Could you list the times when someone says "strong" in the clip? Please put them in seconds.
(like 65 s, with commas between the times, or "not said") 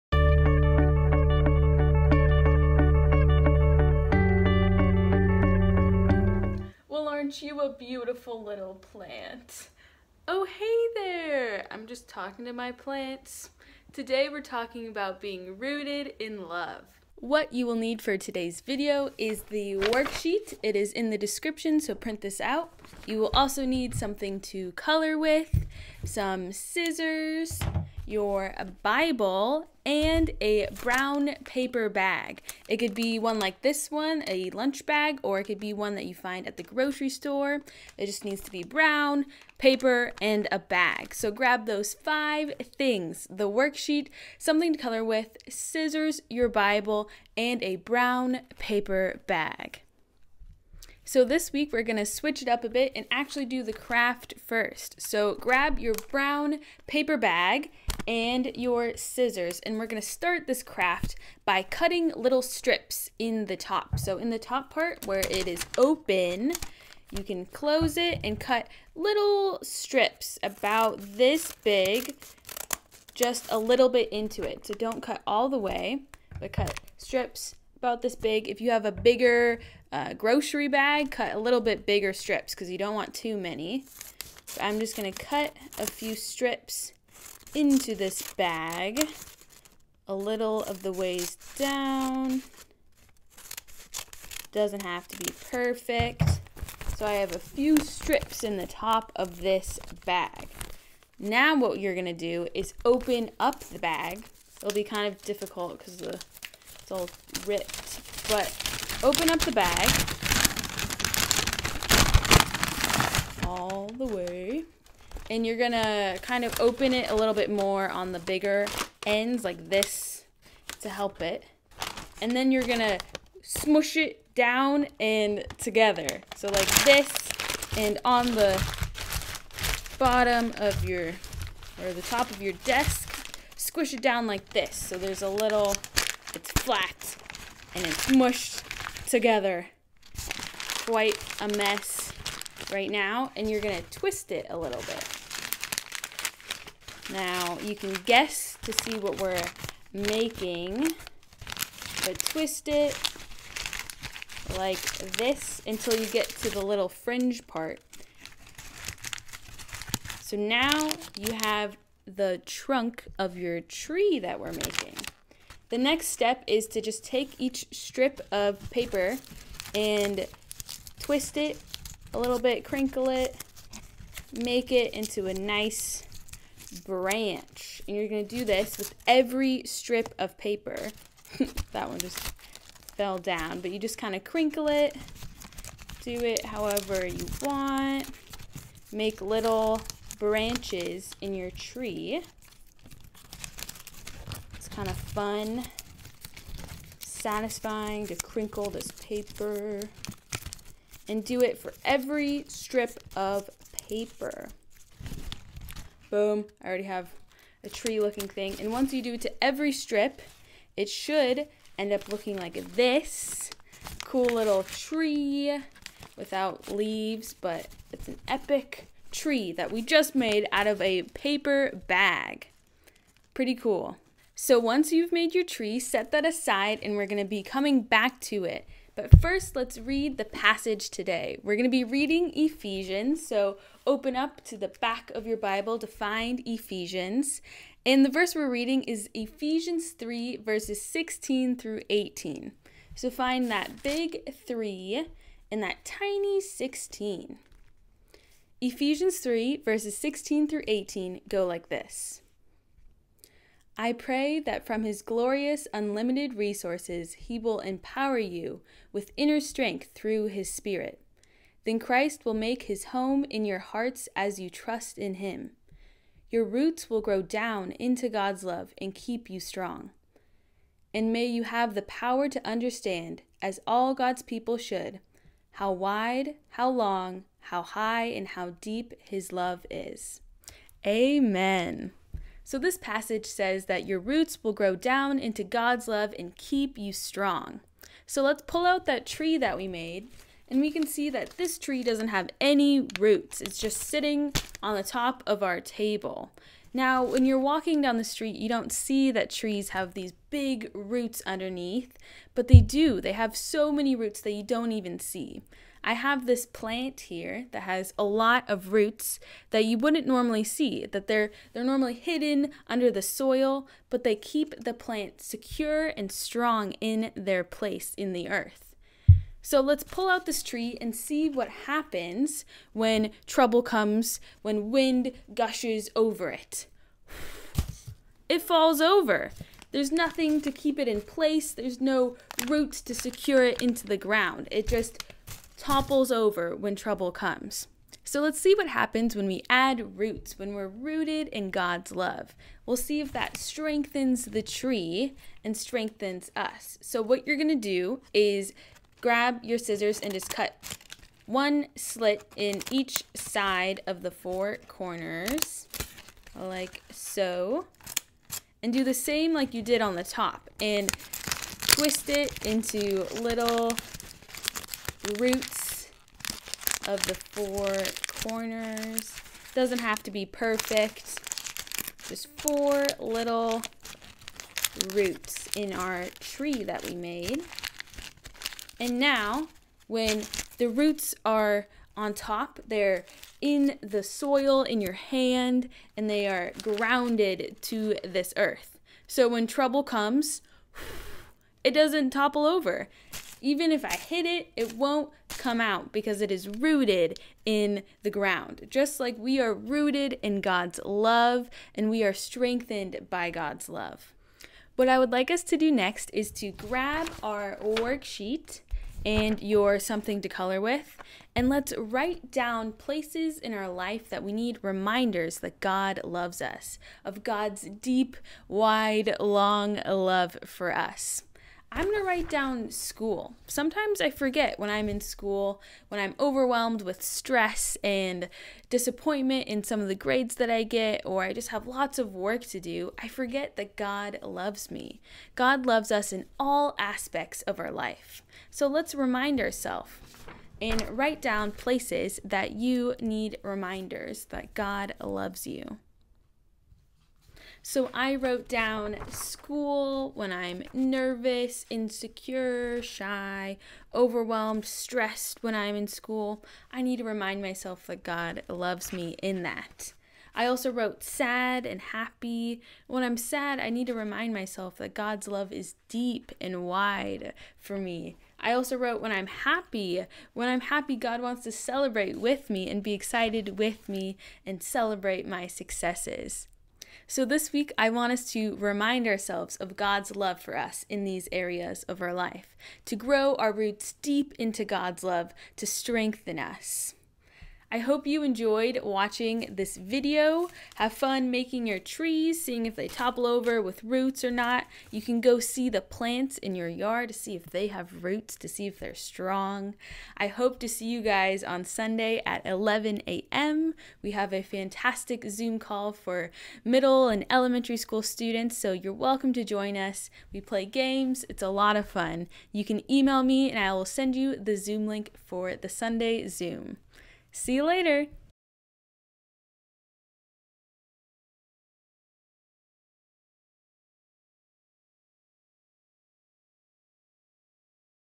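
269 s, 286 s, 316 s, 498 s.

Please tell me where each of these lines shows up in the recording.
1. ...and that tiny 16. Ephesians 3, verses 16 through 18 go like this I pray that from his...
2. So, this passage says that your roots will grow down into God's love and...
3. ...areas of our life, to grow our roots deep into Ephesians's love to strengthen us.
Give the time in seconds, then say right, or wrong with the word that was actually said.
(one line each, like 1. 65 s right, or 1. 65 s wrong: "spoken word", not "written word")
1. 245 s right
2. 282 s right
3. 481 s wrong: "God", not "Ephesians".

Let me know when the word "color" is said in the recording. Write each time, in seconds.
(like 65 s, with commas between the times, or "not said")
24 s, 44 s, 410 s.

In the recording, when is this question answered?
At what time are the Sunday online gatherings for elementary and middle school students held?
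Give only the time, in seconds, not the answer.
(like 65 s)
502 s.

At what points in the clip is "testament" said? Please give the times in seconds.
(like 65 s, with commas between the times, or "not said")
not said.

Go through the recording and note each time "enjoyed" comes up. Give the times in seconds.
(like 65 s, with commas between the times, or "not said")
488 s.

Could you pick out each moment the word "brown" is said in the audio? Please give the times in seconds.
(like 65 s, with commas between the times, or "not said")
30 s, 38 s, 47 s, 56 s.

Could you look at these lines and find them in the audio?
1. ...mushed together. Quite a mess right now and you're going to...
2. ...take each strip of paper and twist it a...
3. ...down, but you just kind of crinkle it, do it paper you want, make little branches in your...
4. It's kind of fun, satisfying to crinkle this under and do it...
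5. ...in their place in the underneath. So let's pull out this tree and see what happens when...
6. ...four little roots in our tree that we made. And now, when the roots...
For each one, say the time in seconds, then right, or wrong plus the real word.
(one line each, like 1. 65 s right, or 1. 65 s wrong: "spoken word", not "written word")
1. 138 s right
2. 167 s right
3. 183 s wrong: "however", not "paper"
4. 194 s wrong: "paper", not "under"
5. 316 s wrong: "earth", not "underneath"
6. 372 s right.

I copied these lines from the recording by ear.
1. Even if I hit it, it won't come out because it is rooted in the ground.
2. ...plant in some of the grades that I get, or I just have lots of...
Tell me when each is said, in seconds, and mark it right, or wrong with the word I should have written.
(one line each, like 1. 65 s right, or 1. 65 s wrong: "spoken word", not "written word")
1. 393 s right
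2. 428 s wrong: "disappointment", not "plant".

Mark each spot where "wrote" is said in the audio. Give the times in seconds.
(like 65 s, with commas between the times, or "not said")
448 s, 460 s, 468 s.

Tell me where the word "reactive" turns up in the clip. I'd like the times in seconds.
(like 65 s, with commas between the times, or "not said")
not said.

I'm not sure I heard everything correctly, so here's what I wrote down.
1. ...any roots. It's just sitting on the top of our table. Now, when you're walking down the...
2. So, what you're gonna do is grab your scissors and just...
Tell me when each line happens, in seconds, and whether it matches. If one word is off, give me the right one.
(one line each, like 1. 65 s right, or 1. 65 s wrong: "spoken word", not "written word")
1. 292 s right
2. 346 s right.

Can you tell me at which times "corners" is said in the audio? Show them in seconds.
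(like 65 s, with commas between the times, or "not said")
354 s, 368 s.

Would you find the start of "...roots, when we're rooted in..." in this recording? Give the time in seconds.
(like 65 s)
339 s.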